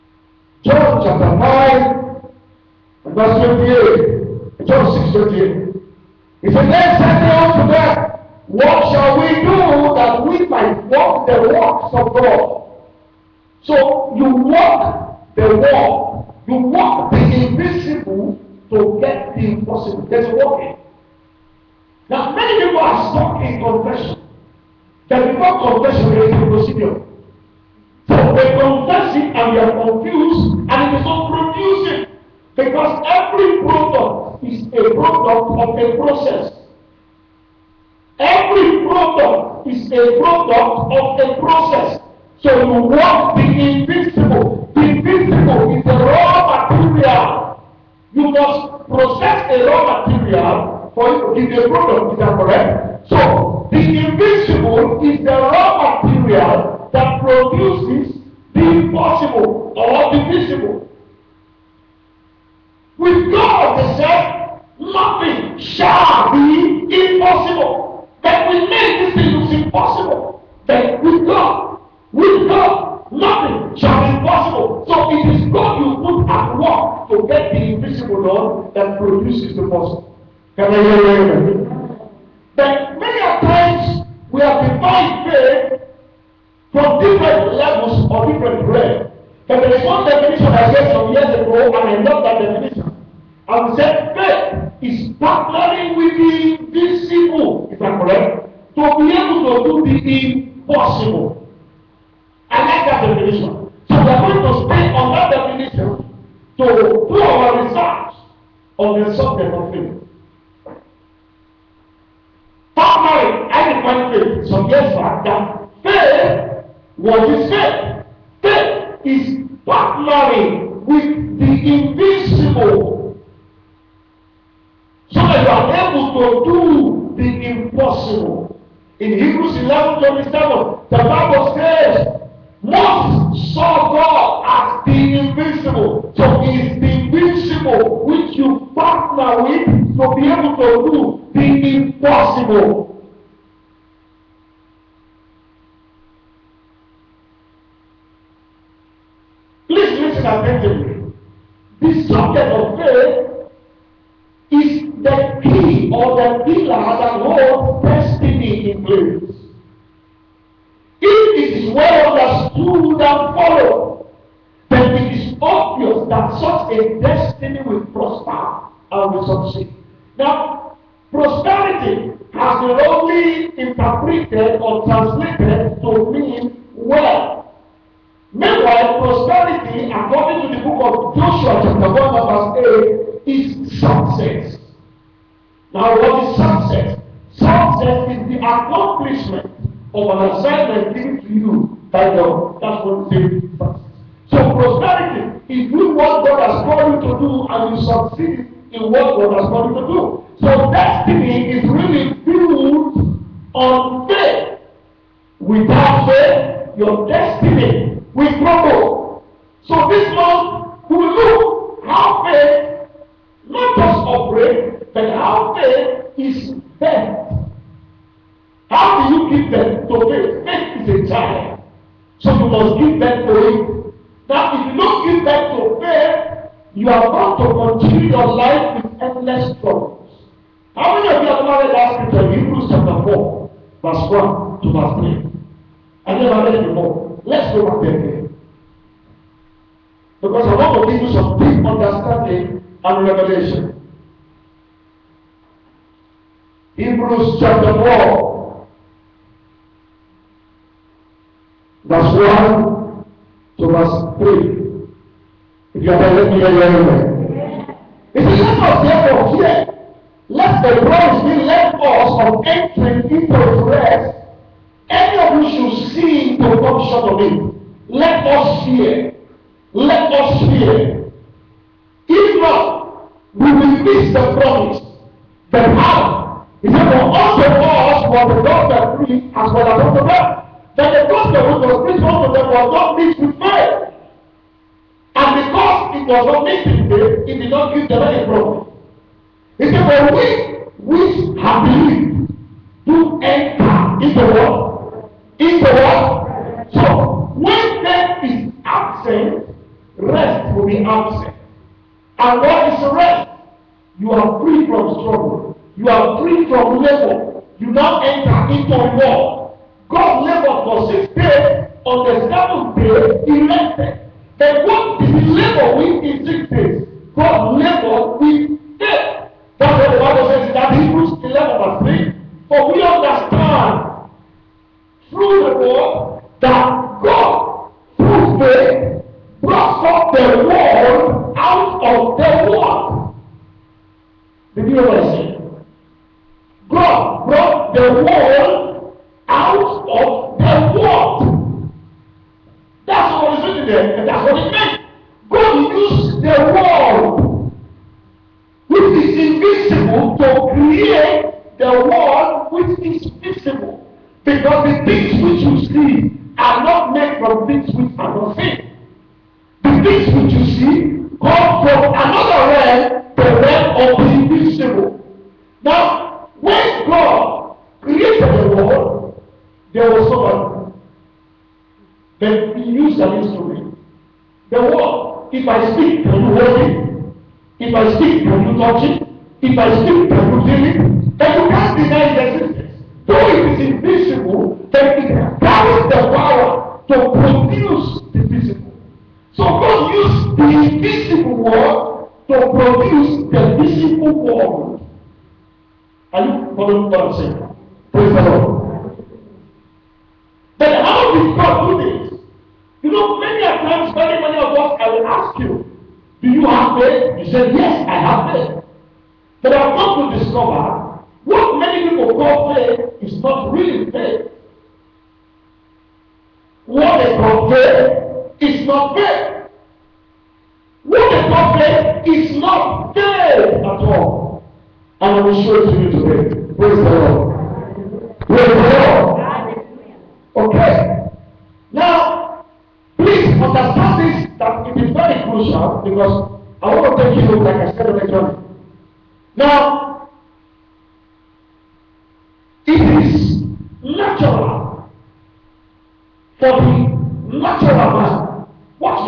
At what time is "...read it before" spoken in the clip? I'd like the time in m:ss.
3:56.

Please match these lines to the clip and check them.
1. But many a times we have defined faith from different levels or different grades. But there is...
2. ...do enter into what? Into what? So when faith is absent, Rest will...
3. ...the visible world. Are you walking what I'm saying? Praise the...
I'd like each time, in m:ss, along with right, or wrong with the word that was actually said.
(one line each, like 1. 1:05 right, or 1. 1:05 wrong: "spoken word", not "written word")
1. 1:22 right
2. 4:52 right
3. 6:33 wrong: "following", not "walking".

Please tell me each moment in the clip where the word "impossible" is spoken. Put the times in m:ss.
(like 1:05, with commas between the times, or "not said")
0:19, 1:40, 2:07, 2:21.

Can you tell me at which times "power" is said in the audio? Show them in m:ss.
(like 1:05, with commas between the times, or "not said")
4:35, 6:26.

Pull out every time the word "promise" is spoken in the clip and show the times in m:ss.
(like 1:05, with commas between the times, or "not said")
4:34, 4:48.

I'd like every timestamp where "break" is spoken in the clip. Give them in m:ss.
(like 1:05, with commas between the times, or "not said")
not said.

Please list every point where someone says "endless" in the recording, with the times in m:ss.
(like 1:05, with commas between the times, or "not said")
3:49.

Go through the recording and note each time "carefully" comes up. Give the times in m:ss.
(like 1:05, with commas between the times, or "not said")
not said.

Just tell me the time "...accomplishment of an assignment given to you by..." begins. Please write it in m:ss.
3:08.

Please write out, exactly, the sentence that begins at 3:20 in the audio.
So, destiny is really built on faith.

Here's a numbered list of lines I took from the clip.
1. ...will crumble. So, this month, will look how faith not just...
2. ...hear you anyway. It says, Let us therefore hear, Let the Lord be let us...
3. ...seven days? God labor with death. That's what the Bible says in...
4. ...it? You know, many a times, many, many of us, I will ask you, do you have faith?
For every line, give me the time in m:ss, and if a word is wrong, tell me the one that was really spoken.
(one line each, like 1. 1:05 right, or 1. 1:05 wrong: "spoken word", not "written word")
1. 3:28 right
2. 4:16 right
3. 5:16 wrong: "six", not "seven"
4. 6:41 right.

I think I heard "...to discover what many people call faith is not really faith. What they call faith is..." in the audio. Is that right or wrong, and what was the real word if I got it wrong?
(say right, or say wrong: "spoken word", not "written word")
right.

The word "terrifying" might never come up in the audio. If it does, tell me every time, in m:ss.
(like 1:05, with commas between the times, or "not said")
not said.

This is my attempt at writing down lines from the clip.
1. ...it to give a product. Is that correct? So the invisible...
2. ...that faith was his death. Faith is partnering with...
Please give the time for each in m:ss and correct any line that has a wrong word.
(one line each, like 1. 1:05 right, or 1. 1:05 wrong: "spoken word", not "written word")
1. 0:51 right
2. 1:55 wrong: "faith", not "death".